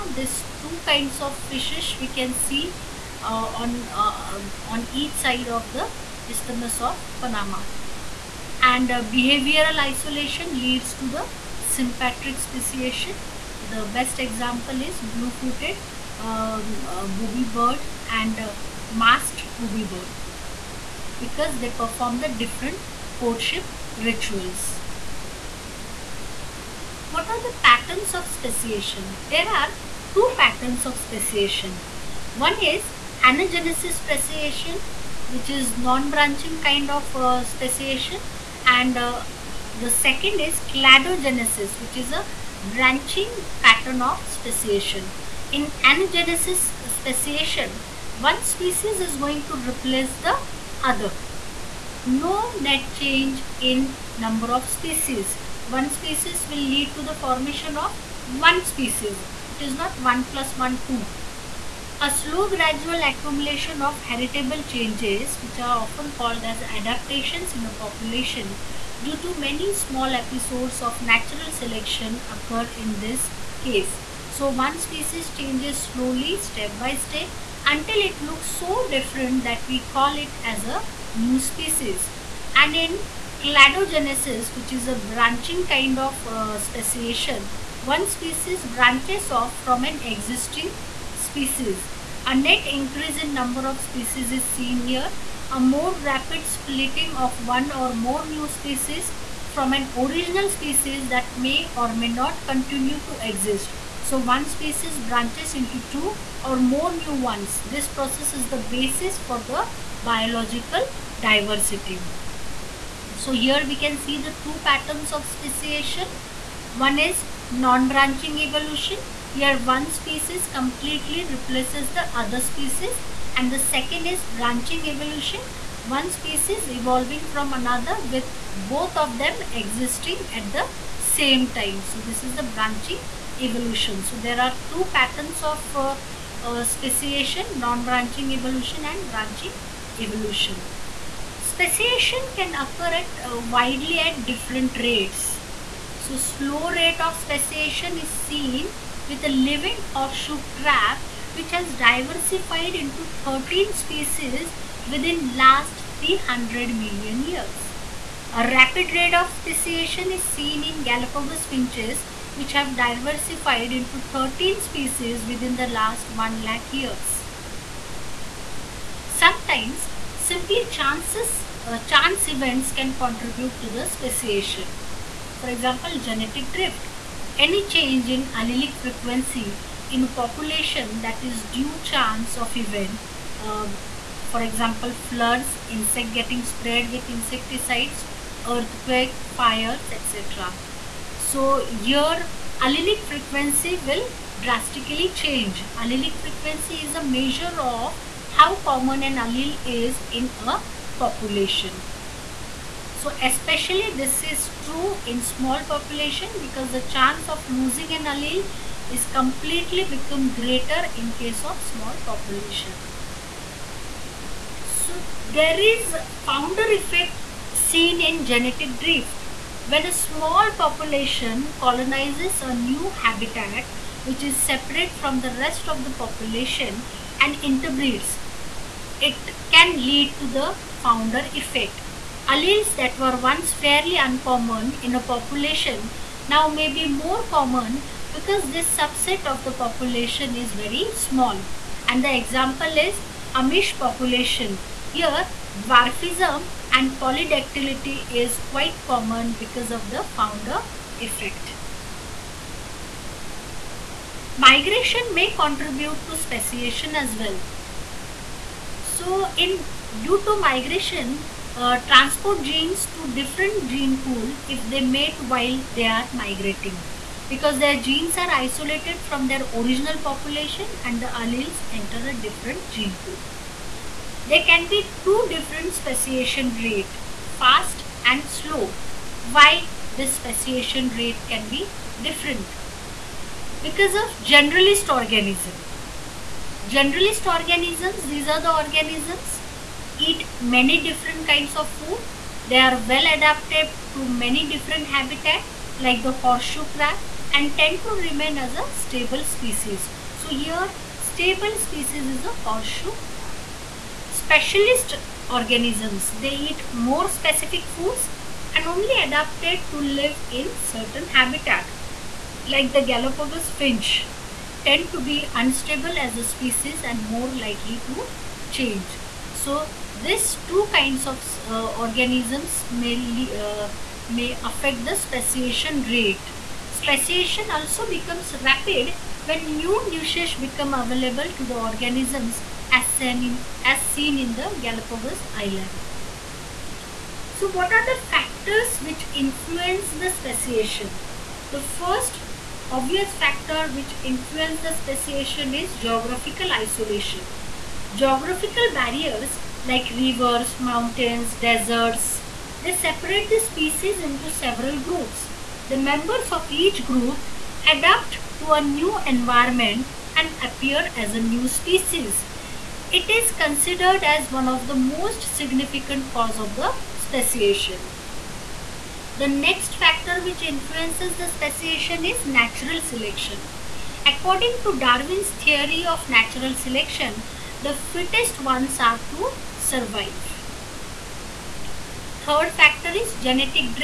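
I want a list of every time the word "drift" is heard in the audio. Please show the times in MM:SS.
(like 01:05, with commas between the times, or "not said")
02:56, 03:38.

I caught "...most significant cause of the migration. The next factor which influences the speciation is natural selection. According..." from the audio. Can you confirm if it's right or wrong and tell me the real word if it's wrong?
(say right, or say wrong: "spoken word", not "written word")
wrong: "speciation", not "migration".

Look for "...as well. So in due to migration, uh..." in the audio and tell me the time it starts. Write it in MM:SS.
04:16.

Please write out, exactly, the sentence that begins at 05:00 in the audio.
So here stable species is a horseshoe crab.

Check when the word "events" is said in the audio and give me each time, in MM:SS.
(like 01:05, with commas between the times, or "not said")
02:52, 03:02.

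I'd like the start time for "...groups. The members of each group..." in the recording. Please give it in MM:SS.
05:54.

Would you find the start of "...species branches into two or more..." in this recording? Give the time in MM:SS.
01:44.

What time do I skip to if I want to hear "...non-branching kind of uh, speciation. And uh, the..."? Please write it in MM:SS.
00:35.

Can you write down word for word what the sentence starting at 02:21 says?
Speciation can occur at uh, widely at different rates.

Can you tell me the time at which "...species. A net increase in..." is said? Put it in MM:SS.
01:31.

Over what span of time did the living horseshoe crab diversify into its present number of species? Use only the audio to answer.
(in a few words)
300 million years.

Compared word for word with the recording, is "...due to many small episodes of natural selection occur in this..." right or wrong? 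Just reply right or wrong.
right.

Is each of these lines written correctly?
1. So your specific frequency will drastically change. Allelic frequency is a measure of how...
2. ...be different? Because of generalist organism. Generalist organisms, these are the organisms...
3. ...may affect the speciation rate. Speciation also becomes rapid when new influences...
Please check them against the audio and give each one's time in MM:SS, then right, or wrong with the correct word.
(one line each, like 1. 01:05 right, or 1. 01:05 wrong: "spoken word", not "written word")
1. 03:11 wrong: "allelic", not "specific"
2. 04:41 right
3. 05:24 wrong: "niches", not "influences".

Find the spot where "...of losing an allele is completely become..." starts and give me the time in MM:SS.
03:27.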